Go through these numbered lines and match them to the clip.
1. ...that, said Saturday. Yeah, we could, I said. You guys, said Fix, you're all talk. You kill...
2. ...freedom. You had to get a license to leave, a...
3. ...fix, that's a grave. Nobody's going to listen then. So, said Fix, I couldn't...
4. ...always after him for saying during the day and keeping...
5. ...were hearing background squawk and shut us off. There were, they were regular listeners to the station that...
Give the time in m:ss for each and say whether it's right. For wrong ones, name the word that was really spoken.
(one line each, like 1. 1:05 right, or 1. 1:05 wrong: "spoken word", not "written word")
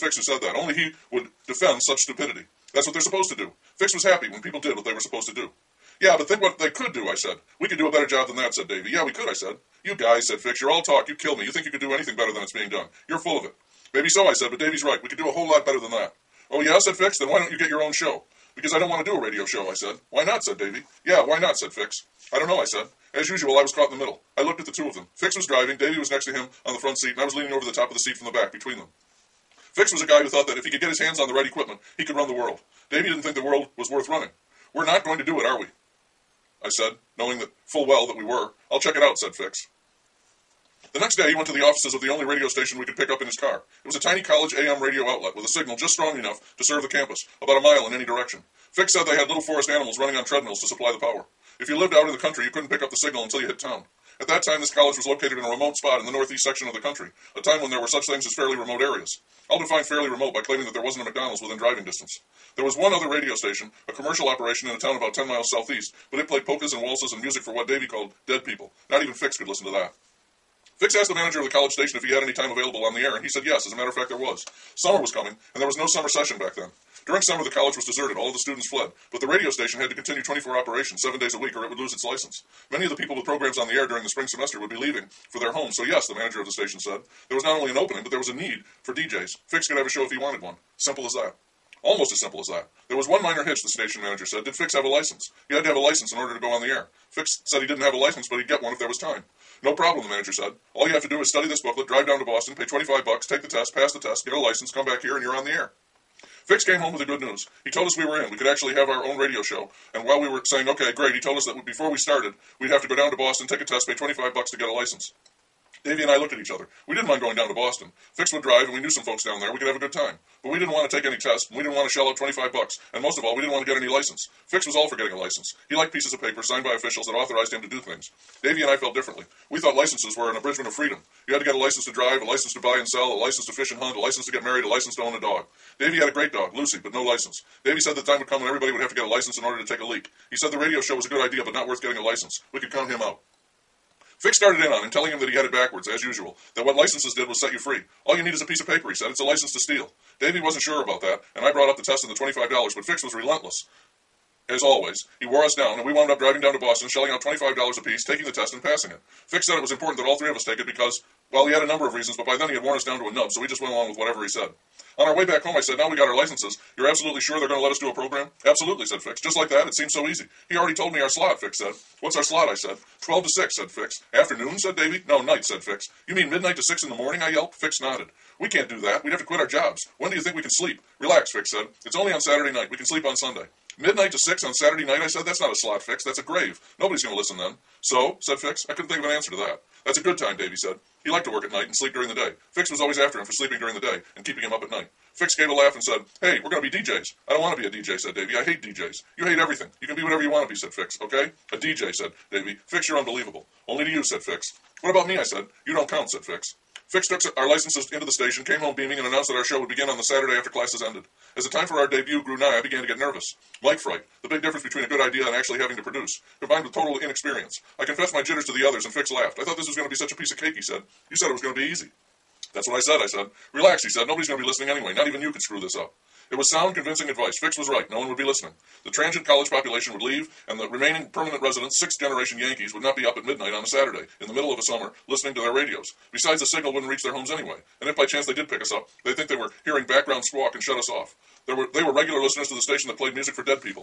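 1. 0:08 wrong: "Davy", not "Saturday"
2. 2:10 wrong: "drive", not "leave"
3. 3:05 right
4. 3:12 wrong: "sleeping", not "saying"
5. 3:59 right.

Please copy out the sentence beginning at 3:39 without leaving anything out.
I thought this was going to be such a piece of cake, he said.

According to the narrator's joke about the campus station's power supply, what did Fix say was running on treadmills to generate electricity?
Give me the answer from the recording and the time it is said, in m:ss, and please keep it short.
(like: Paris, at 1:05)
little forest animals, at 0:49.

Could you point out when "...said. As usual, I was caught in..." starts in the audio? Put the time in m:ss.
0:22.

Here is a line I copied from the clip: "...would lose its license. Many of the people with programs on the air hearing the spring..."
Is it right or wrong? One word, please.
wrong.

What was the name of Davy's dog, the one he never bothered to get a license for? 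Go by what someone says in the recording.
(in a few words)
Lucy.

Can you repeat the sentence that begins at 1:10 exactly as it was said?
Fix asked the manager of the college station if he had any time available on the air, and he said yes.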